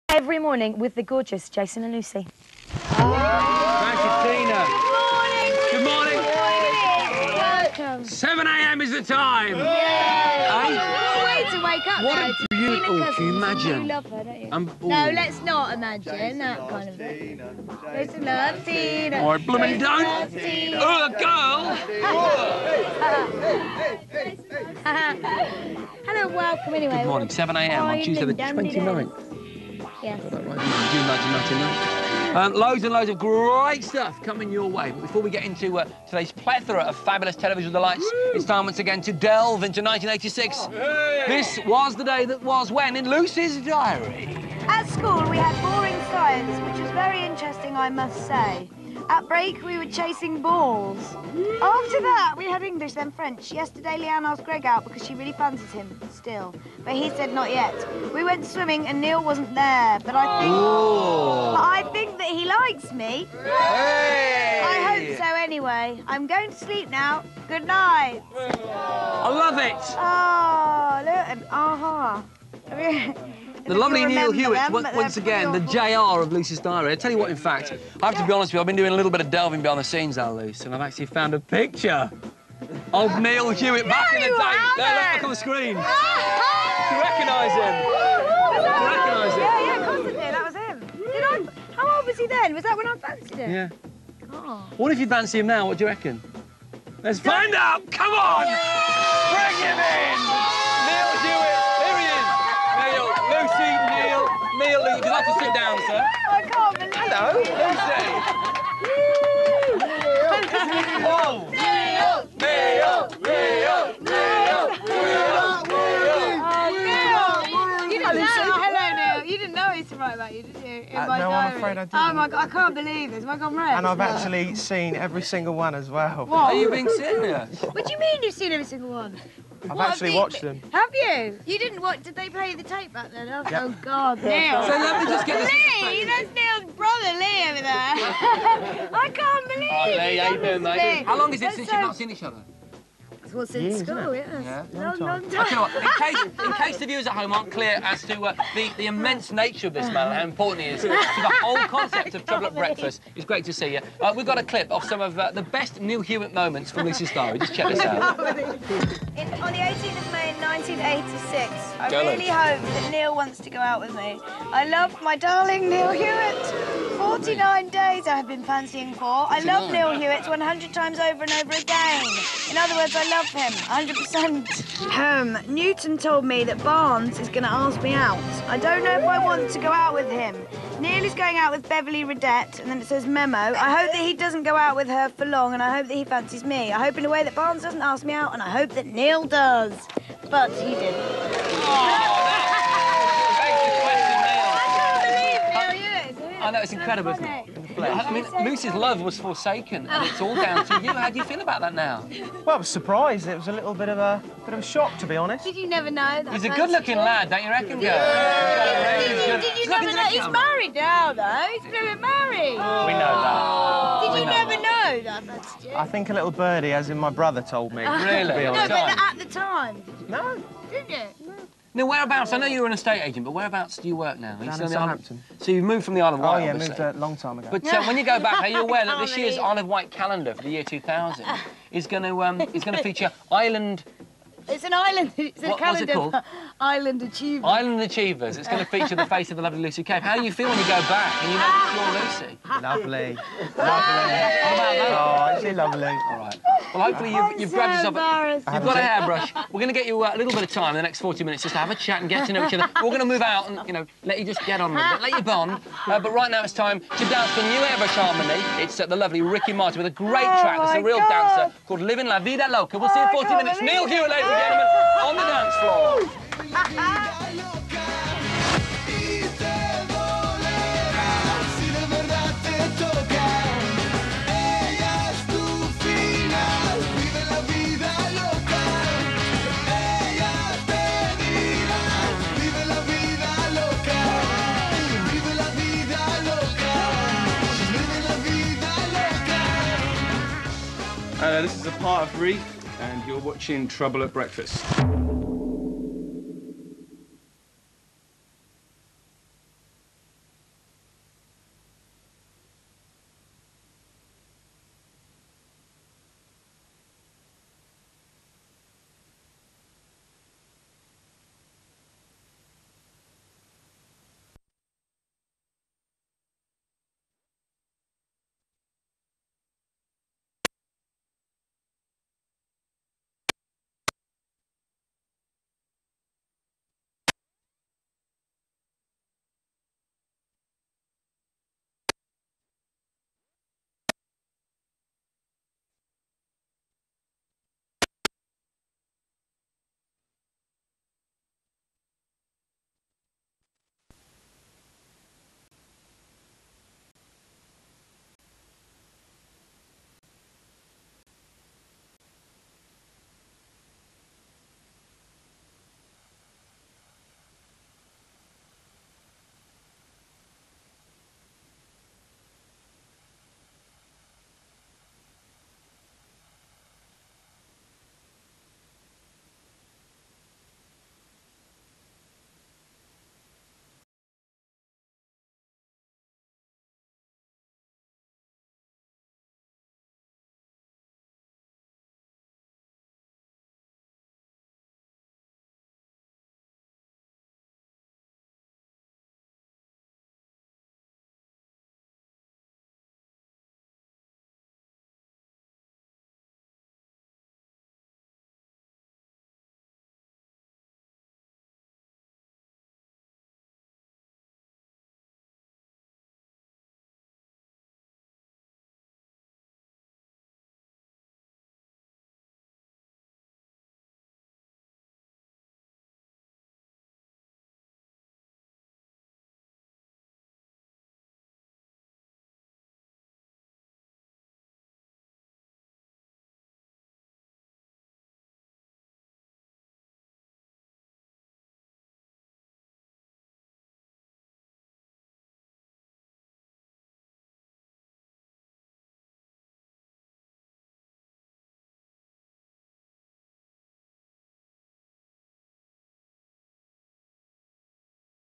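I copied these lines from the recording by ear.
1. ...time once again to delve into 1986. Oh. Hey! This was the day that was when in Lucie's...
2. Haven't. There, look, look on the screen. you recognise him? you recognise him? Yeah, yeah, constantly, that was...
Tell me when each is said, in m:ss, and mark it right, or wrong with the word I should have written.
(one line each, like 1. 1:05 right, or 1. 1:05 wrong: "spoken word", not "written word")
1. 0:38 right
2. 1:24 right.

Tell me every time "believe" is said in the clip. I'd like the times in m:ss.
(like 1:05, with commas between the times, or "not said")
2:02, 2:19.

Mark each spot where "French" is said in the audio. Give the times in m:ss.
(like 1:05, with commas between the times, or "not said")
0:53.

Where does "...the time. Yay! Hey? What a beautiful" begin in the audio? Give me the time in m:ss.
0:08.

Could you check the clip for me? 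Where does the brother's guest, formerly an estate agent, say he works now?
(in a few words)
Southampton.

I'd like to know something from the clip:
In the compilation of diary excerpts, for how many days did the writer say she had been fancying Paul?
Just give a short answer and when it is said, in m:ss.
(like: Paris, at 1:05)
49, at 2:46.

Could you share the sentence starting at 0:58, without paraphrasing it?
We went swimming and Neil wasn't there, but I think...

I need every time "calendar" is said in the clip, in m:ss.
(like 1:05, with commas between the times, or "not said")
3:49, 3:55.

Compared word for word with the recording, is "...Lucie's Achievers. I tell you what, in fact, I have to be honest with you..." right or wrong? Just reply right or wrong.
wrong.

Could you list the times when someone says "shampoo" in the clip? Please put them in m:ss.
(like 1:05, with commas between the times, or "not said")
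not said.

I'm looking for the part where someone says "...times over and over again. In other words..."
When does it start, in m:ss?
2:50.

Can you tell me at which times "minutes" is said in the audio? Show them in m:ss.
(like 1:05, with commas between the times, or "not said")
4:11, 4:23.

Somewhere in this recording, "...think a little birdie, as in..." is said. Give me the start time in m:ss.
3:35.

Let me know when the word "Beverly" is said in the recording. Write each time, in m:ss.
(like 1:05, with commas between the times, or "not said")
3:01.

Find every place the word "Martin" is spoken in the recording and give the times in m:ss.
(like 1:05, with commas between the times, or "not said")
4:19.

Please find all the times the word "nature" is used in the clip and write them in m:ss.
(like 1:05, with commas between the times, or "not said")
2:29.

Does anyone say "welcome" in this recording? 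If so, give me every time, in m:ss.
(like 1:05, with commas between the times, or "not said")
0:07, 0:26.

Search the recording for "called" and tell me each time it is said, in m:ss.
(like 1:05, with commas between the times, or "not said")
3:56, 4:21.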